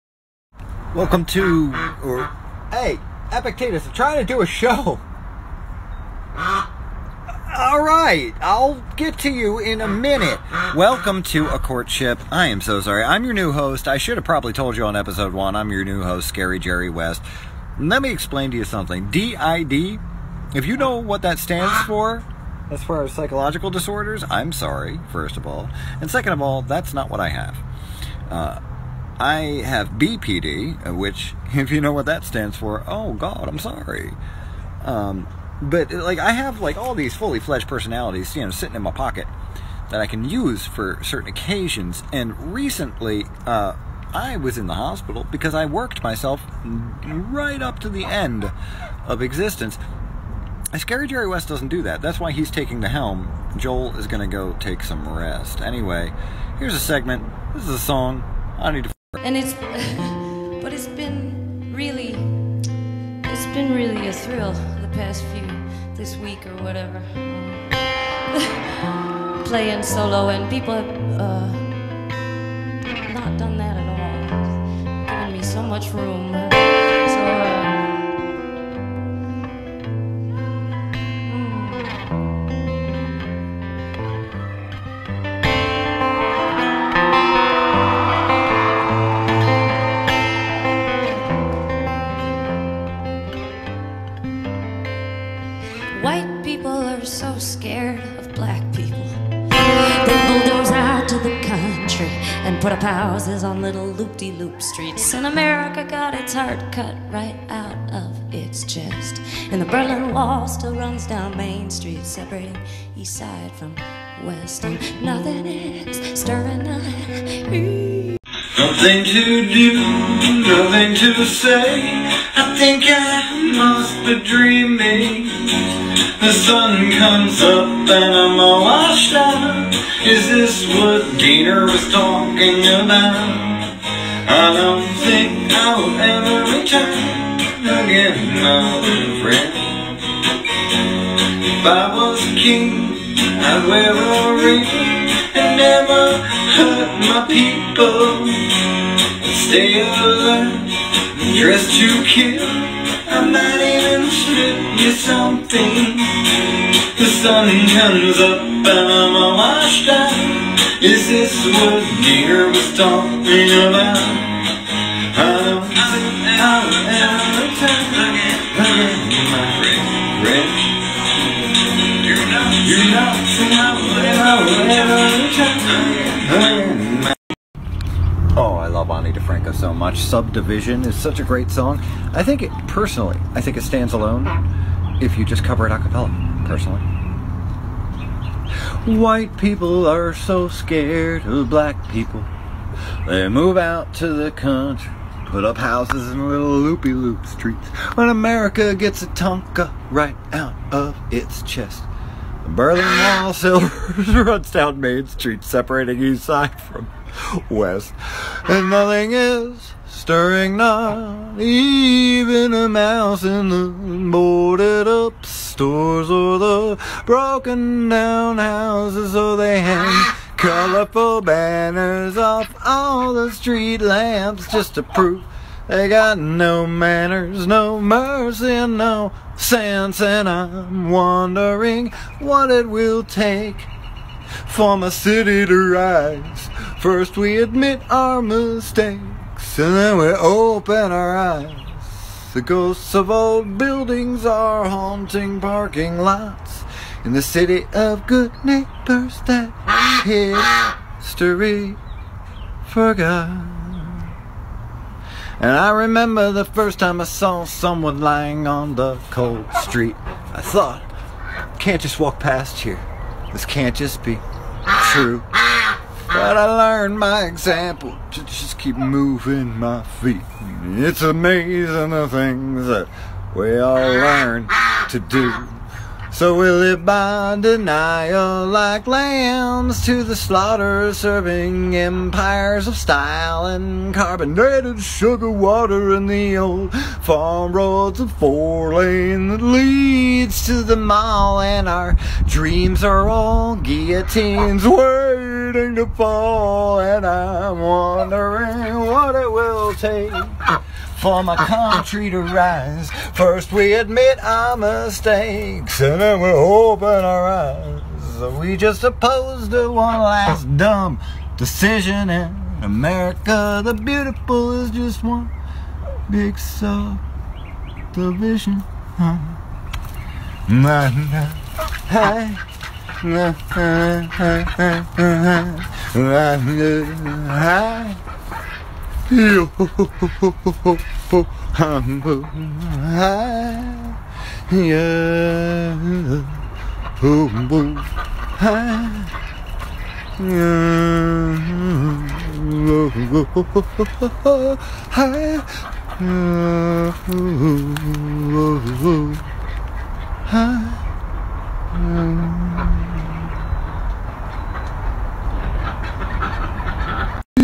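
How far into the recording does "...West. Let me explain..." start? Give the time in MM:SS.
00:16.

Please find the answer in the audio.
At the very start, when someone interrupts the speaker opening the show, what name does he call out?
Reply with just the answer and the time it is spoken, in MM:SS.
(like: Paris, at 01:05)
Epictetus, at 00:03.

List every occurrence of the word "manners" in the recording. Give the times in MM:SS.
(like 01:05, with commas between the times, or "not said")
03:46.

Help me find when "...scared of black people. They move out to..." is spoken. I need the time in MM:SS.
03:10.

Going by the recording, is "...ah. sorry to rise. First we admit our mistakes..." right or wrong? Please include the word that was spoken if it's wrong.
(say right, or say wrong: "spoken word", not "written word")
wrong: "country", not "sorry".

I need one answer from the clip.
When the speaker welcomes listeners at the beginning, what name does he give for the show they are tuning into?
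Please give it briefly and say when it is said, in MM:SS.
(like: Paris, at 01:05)
A Courtship, at 00:11.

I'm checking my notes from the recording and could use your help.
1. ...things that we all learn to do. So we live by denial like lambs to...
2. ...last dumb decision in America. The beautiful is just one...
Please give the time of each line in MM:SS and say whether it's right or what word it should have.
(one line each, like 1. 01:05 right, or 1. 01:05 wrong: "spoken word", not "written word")
1. 04:32 right
2. 05:09 right.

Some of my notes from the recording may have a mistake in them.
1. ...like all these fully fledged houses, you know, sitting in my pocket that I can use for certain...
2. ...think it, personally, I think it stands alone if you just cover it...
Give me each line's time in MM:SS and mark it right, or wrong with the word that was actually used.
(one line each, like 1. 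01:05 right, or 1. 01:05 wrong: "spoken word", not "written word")
1. 00:36 wrong: "personalities", not "houses"
2. 03:02 right.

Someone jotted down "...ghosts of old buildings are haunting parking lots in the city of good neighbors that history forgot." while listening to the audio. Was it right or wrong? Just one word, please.
right.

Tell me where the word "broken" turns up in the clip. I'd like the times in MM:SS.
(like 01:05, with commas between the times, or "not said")
03:37.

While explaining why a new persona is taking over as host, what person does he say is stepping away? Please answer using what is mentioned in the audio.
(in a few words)
Joel.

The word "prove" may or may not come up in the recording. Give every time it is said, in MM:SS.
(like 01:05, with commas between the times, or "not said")
03:44.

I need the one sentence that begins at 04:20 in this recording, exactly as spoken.
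I thought, can't just walk past here.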